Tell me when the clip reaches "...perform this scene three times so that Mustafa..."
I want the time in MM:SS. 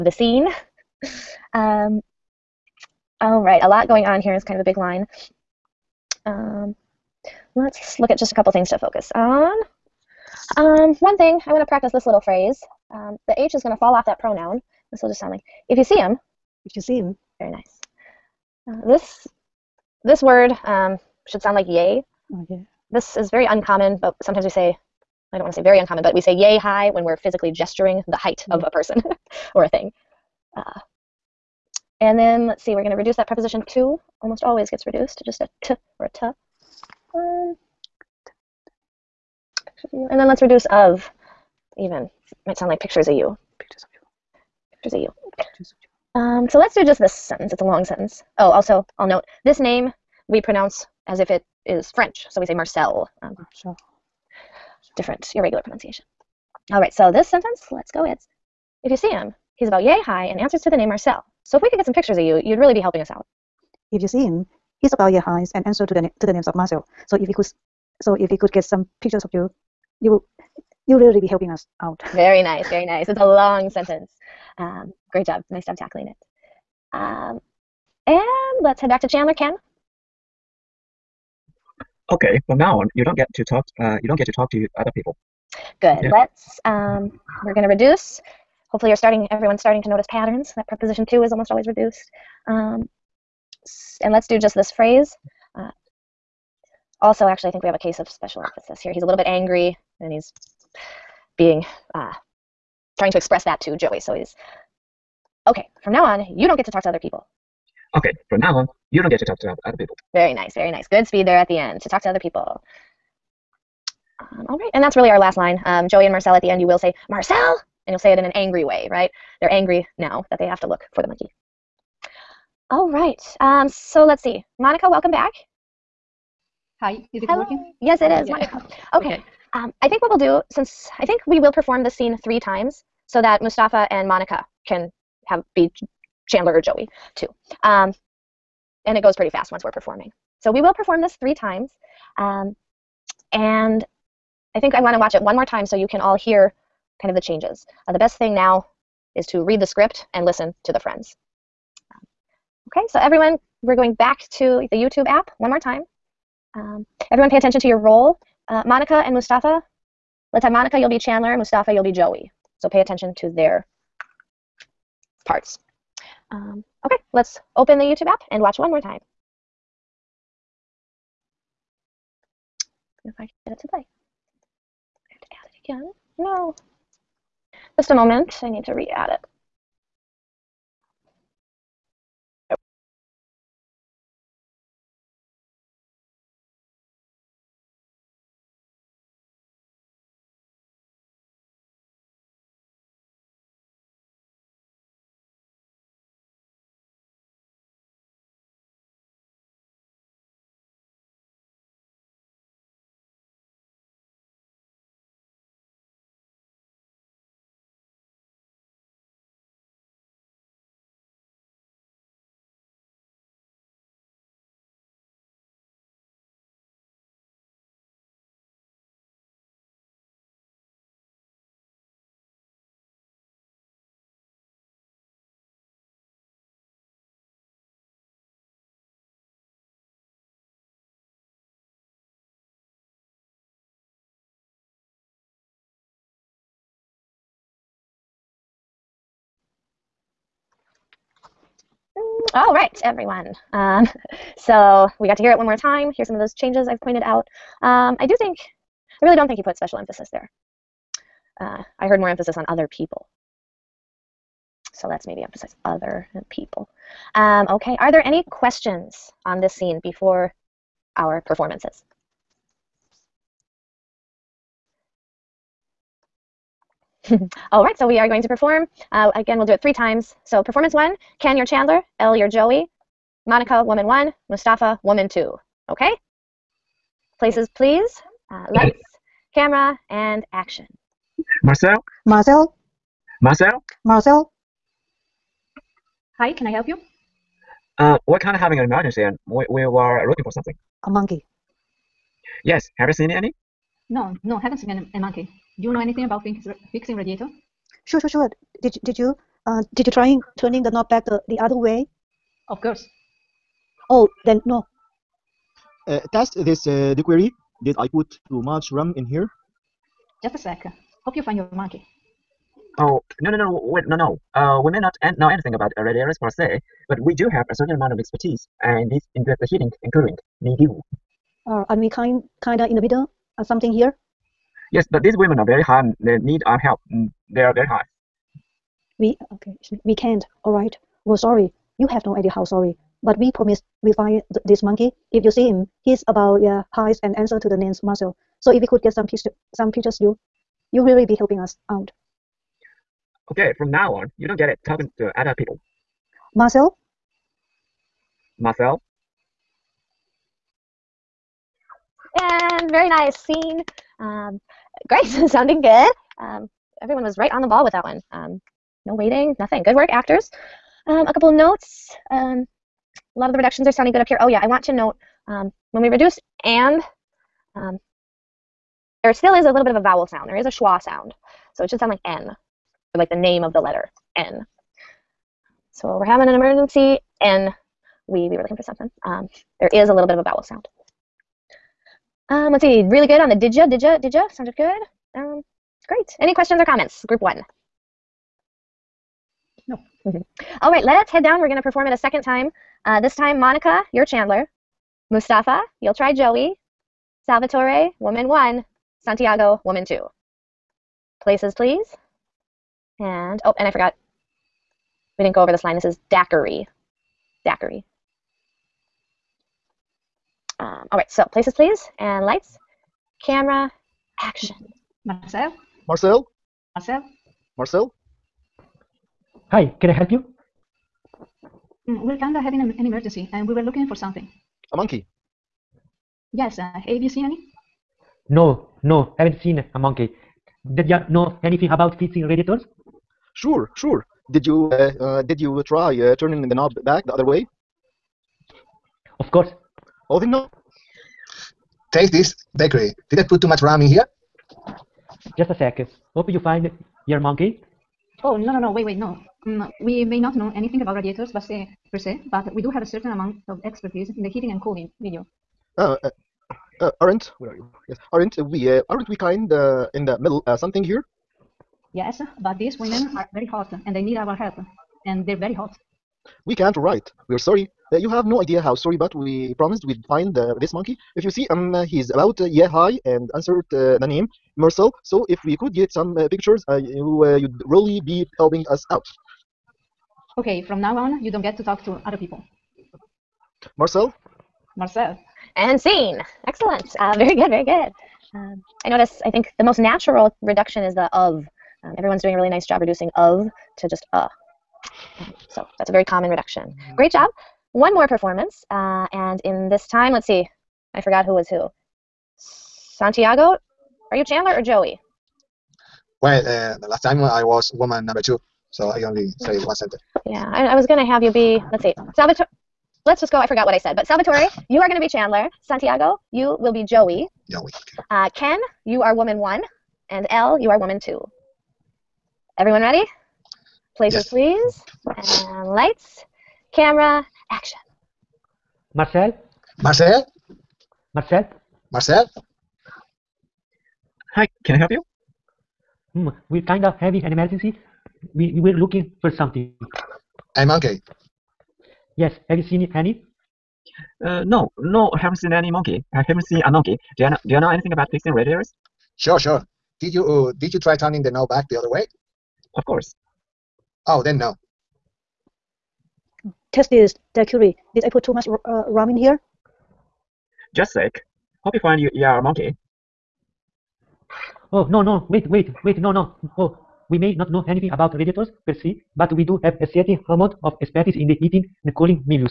02:11.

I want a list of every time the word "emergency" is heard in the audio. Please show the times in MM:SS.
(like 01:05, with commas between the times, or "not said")
04:48, 06:16, 07:02, 08:57.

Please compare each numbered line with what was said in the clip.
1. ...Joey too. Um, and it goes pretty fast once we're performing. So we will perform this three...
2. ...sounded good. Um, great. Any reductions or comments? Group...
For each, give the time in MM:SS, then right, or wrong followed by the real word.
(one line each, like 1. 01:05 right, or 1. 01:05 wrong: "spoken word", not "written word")
1. 02:16 right
2. 06:24 wrong: "questions", not "reductions".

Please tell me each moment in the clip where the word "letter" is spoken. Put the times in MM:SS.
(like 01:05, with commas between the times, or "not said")
06:13.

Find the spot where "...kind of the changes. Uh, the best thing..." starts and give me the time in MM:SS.
02:27.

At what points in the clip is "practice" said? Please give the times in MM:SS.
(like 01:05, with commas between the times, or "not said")
00:11.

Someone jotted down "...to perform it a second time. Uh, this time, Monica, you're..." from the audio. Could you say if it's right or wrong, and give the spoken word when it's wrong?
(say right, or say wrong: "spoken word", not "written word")
right.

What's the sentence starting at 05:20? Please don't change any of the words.
We Uh, and we kind kinda in the middle, of something here.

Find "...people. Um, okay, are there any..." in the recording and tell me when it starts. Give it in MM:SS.
04:16.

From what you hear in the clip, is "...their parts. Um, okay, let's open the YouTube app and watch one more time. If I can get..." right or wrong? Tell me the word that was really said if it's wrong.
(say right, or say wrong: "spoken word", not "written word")
right.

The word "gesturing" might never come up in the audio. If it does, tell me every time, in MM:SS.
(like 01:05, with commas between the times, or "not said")
00:27.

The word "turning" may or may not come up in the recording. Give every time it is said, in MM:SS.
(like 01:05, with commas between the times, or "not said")
05:00, 07:16, 09:10.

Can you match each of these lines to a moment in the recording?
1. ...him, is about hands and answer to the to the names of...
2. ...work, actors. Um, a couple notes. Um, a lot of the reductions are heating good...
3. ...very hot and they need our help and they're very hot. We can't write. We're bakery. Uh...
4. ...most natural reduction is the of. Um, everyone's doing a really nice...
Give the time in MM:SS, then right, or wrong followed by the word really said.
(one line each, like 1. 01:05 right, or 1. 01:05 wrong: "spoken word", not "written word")
1. 01:04 right
2. 05:59 wrong: "sounding", not "heating"
3. 07:43 wrong: "sorry", not "bakery"
4. 08:09 right.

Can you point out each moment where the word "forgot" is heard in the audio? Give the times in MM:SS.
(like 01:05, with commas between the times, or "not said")
06:43, 08:21, 08:33.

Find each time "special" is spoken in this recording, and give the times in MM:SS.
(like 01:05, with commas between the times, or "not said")
01:38, 04:09.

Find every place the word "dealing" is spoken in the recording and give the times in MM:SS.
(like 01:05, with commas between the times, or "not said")
not said.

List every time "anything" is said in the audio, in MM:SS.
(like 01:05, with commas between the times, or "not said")
04:55, 05:15, 07:11, 07:30, 09:07, 09:27.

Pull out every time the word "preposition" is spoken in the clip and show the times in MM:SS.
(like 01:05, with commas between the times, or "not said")
00:33, 01:30.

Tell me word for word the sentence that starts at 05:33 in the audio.
But we promise we find th this monkey.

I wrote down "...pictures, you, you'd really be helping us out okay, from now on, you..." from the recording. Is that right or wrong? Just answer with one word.
right.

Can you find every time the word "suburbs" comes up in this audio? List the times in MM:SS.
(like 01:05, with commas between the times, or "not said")
not said.